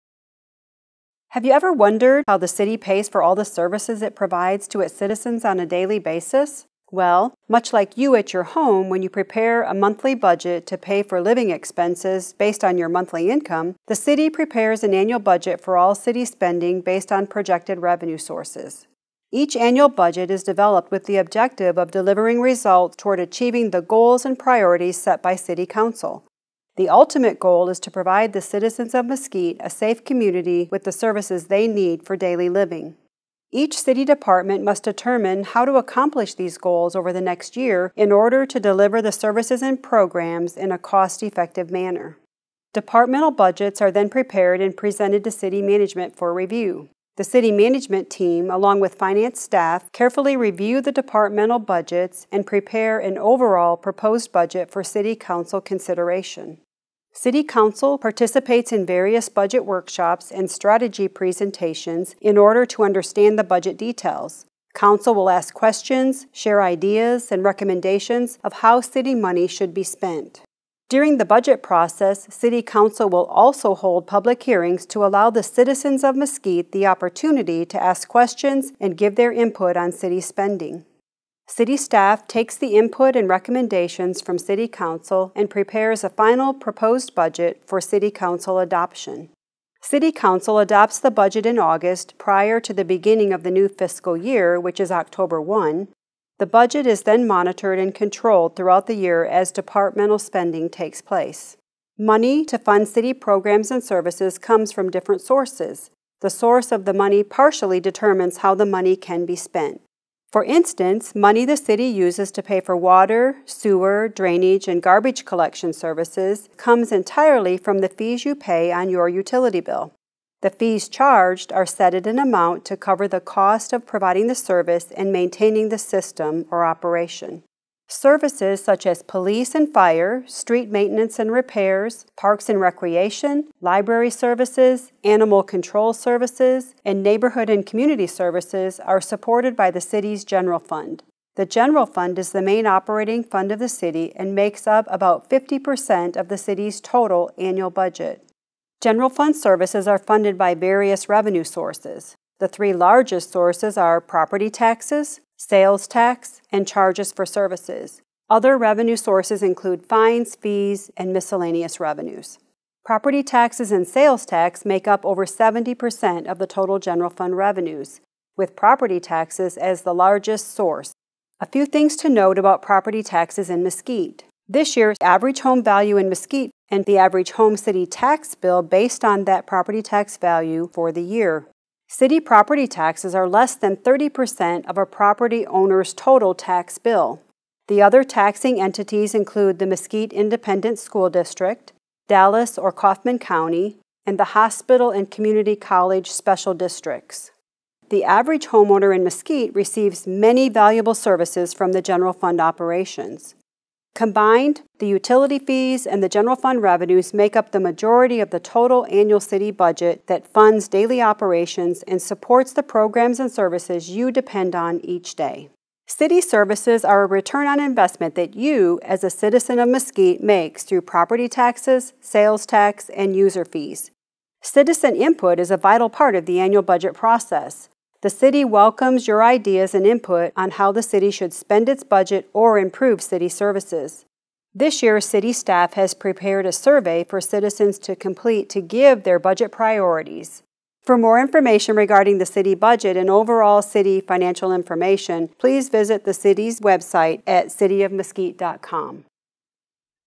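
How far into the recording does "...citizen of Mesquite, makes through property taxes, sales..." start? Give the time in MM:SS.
03:39.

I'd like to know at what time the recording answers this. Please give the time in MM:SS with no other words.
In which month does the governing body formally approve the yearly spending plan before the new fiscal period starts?
01:31.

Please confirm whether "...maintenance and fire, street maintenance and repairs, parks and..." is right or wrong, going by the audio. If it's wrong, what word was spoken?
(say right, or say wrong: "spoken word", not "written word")
wrong: "police", not "maintenance".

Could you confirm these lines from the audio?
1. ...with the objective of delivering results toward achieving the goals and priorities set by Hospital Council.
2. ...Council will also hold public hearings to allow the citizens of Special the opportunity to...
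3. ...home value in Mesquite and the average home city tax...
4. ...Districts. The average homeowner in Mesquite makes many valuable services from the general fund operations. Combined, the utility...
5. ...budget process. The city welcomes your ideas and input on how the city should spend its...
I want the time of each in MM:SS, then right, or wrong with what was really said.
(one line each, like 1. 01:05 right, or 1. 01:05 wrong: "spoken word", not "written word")
1. 00:20 wrong: "City", not "Hospital"
2. 01:12 wrong: "Mesquite", not "Special"
3. 02:55 right
4. 03:16 wrong: "receives", not "makes"
5. 03:46 right.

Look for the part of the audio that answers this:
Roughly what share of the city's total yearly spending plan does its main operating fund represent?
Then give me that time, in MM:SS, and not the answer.
02:25.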